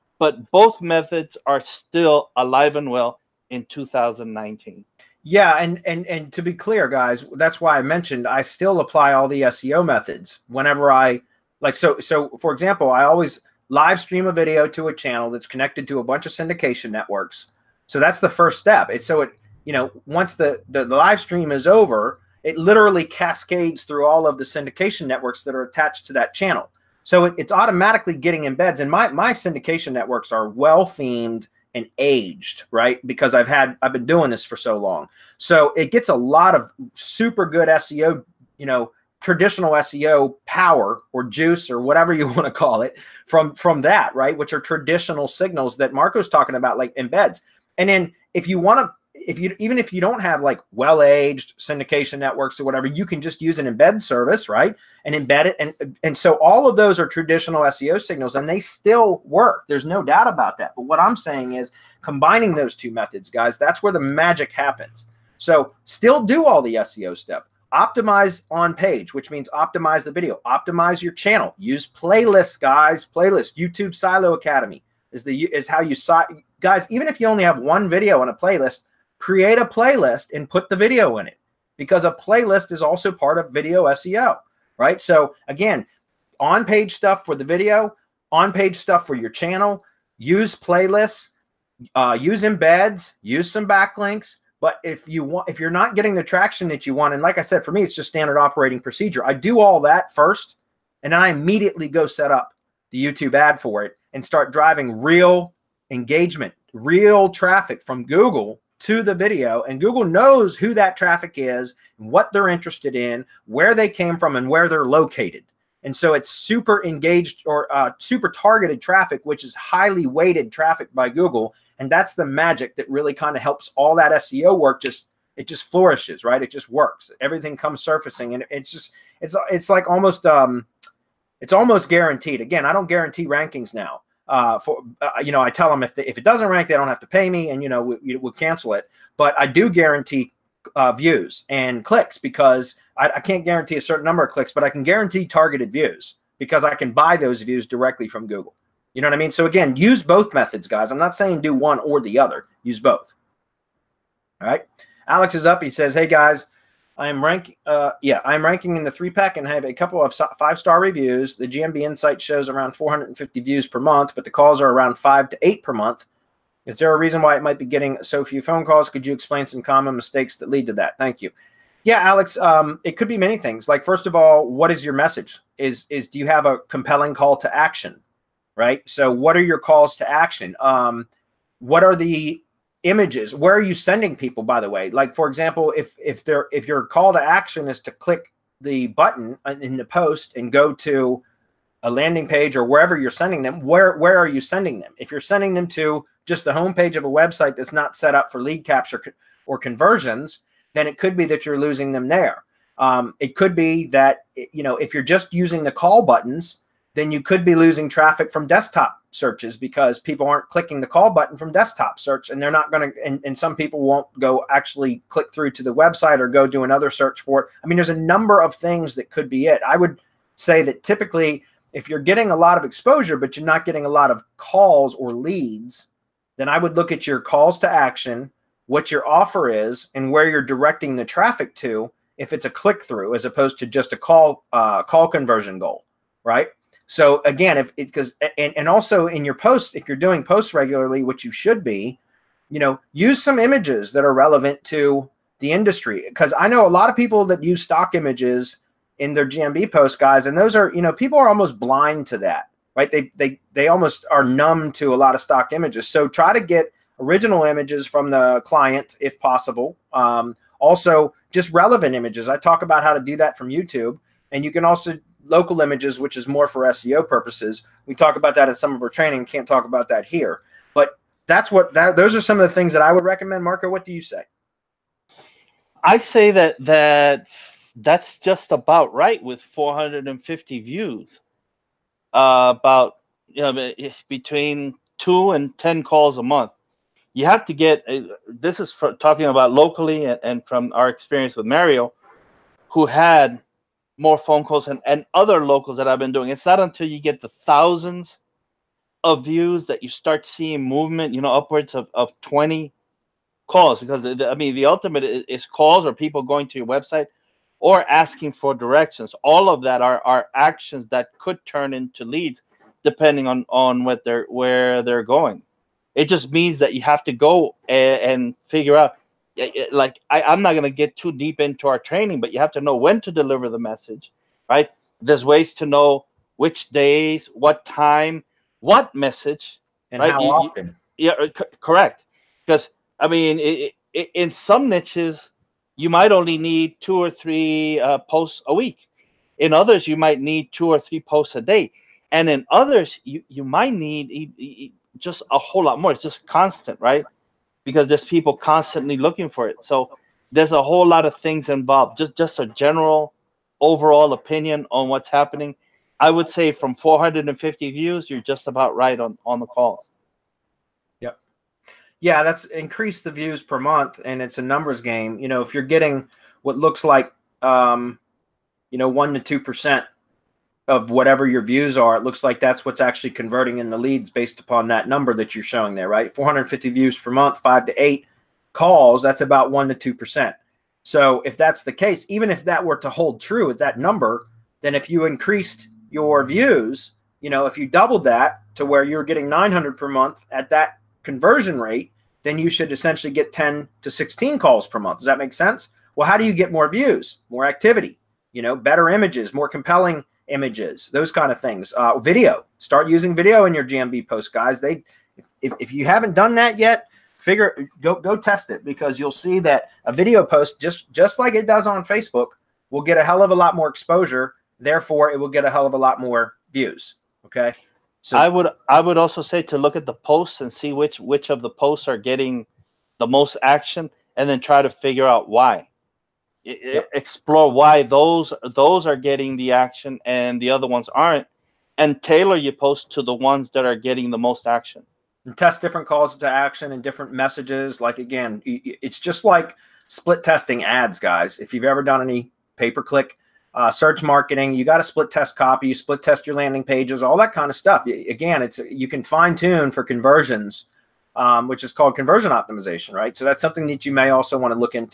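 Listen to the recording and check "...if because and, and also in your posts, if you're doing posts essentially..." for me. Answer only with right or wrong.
wrong.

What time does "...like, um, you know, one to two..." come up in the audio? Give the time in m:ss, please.
6:06.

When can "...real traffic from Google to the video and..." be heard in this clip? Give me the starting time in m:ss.
1:46.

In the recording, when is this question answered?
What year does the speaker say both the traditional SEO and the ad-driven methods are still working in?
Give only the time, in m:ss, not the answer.
0:03.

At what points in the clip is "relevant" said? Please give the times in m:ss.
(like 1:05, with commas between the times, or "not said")
4:04, 4:21.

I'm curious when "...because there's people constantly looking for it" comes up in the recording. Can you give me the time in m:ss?
5:47.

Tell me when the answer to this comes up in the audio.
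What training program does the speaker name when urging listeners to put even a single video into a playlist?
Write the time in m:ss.
1:13.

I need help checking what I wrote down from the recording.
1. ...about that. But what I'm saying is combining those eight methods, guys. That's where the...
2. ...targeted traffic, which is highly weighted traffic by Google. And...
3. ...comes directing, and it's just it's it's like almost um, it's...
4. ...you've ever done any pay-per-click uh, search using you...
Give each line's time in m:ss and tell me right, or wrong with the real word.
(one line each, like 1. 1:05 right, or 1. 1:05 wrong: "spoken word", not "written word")
1. 1:00 wrong: "two", not "eight"
2. 1:58 right
3. 2:07 wrong: "surfacing", not "directing"
4. 7:21 wrong: "marketing", not "using".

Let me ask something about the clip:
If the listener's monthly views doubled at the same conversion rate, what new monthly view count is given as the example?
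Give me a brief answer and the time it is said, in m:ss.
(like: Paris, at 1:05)
900, at 6:29.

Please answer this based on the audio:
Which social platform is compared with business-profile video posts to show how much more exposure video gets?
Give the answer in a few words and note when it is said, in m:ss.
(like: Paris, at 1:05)
Facebook, at 6:51.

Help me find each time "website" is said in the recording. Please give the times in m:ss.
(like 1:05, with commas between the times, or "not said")
3:17, 3:35, 5:06.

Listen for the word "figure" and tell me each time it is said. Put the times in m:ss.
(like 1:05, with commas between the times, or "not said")
5:18, 6:47, 7:04.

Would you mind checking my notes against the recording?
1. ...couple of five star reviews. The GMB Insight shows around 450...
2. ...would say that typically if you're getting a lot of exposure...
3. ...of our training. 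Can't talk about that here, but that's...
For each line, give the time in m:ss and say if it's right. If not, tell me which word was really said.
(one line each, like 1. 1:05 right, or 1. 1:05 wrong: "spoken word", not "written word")
1. 2:39 right
2. 3:39 right
3. 4:28 right.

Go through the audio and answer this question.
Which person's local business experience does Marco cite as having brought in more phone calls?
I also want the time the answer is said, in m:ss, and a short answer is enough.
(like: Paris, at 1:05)
Mario, at 4:51.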